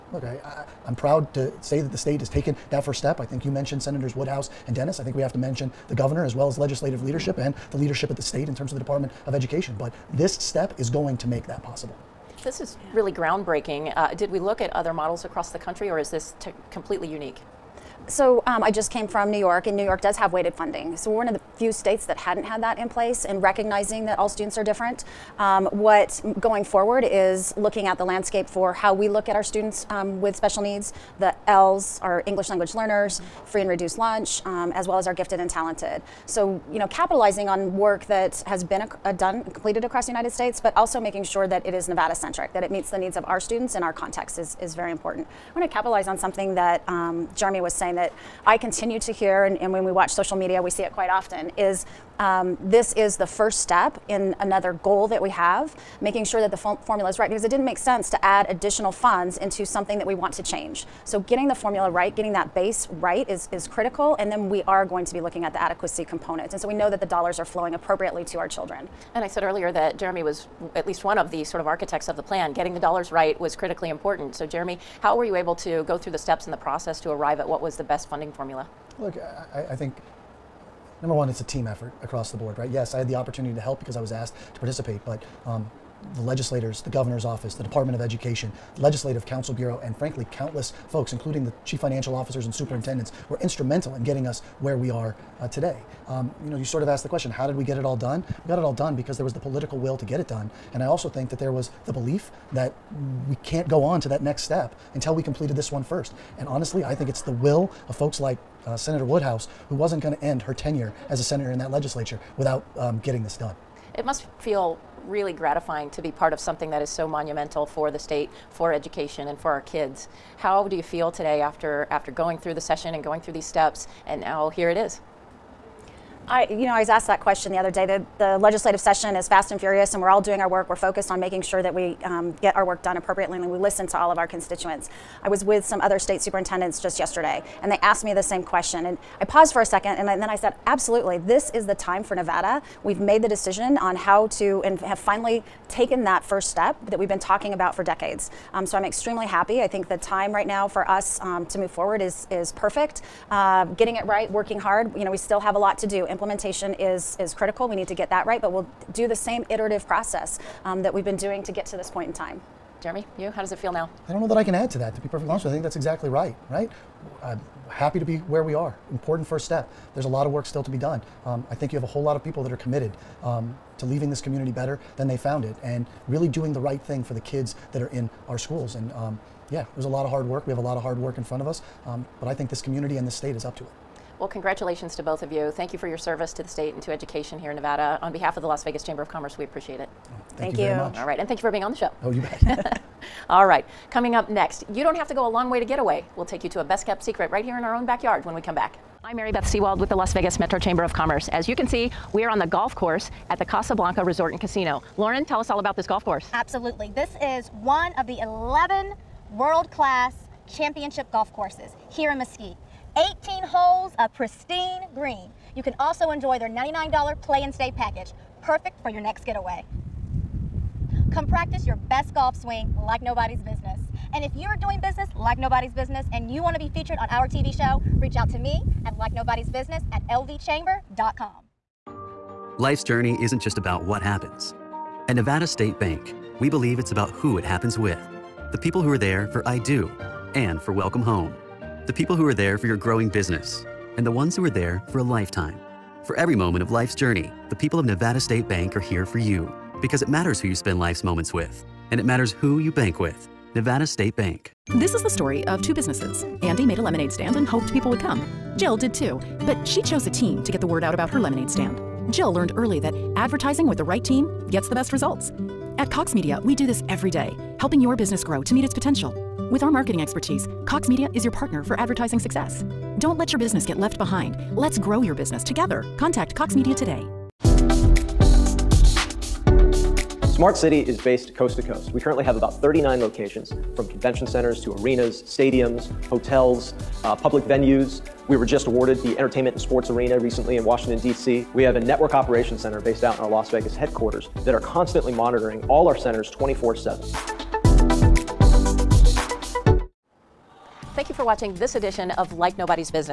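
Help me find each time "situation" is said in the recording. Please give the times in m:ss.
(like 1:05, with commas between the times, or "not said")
not said.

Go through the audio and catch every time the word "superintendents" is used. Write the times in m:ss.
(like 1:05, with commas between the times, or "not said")
1:32, 2:16.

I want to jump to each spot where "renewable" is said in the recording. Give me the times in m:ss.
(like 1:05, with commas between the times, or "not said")
not said.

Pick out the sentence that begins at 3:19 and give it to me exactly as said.
I'm Mary Beth Sewald with the Las Vegas Metro Chamber of Commerce.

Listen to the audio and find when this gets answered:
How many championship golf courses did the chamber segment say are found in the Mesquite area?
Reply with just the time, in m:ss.
3:28.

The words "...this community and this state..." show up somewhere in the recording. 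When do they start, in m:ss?
3:02.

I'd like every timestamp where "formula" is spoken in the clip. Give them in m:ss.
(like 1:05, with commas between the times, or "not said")
0:56, 1:01, 1:18.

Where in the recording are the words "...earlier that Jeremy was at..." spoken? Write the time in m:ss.
1:09.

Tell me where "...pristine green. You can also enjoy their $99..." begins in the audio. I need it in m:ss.
3:34.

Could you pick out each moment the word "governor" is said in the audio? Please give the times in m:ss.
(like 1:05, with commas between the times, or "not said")
0:05, 1:26.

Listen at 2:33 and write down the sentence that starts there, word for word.
Uh, getting it right, working hard.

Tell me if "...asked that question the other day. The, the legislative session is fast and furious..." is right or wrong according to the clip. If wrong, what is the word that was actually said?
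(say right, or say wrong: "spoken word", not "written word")
right.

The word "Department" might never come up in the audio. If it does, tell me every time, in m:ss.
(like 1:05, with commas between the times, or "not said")
0:08, 1:27.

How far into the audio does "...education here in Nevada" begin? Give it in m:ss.
3:06.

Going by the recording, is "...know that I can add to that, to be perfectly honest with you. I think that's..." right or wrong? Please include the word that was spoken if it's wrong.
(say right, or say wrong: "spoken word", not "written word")
right.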